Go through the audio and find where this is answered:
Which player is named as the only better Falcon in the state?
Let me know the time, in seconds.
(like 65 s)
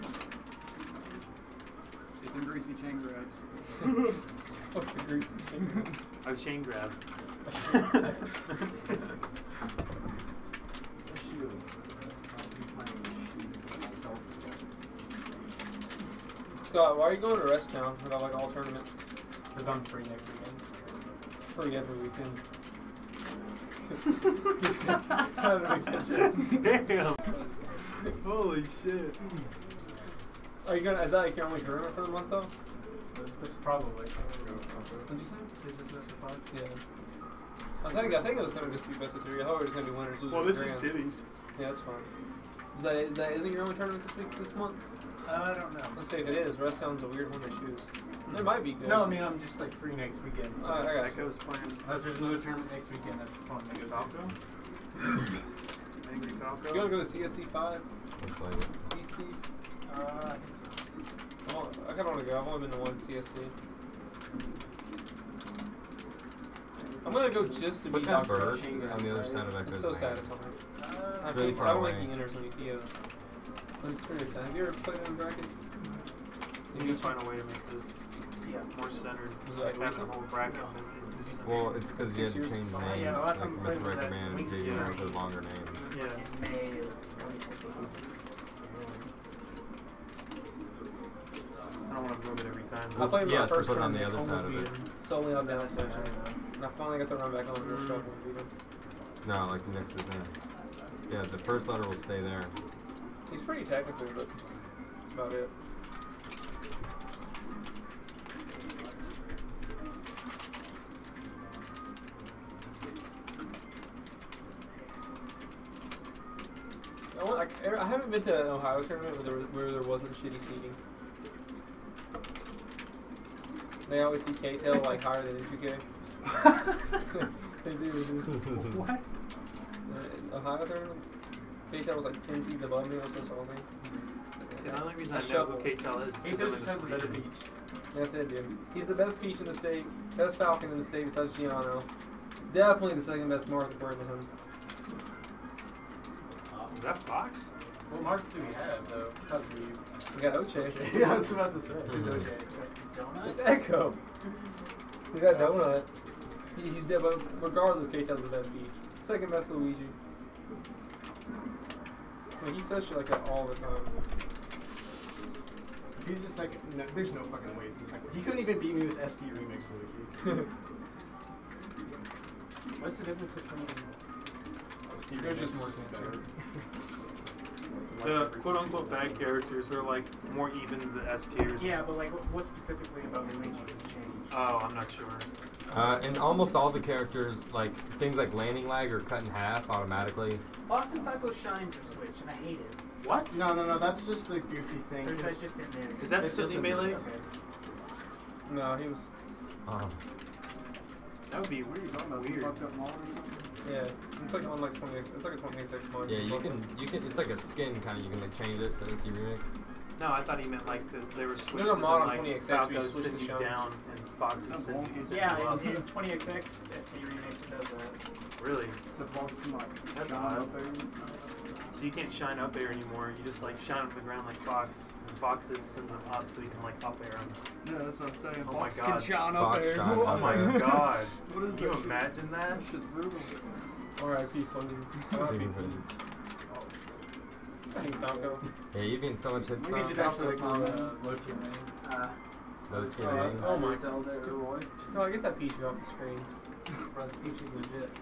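141 s.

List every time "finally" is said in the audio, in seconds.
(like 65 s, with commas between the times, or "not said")
96 s.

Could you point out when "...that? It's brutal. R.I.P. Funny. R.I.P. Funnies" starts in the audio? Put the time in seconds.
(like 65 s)
232 s.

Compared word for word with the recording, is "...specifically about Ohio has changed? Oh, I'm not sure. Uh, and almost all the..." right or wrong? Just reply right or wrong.
wrong.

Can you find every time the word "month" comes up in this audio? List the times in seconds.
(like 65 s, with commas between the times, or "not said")
32 s, 44 s.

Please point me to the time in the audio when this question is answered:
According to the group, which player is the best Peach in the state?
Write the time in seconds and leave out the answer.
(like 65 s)
157 s.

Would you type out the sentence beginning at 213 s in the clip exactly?
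down and Fox sends you you Yeah, in, 20XX, SD Remix does that.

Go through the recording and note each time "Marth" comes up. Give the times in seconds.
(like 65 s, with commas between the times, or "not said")
143 s, 148 s.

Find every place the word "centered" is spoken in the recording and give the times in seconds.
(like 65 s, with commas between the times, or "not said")
78 s.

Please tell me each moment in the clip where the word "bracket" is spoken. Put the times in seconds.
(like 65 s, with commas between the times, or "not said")
75 s, 80 s.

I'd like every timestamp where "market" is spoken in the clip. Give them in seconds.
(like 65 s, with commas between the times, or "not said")
not said.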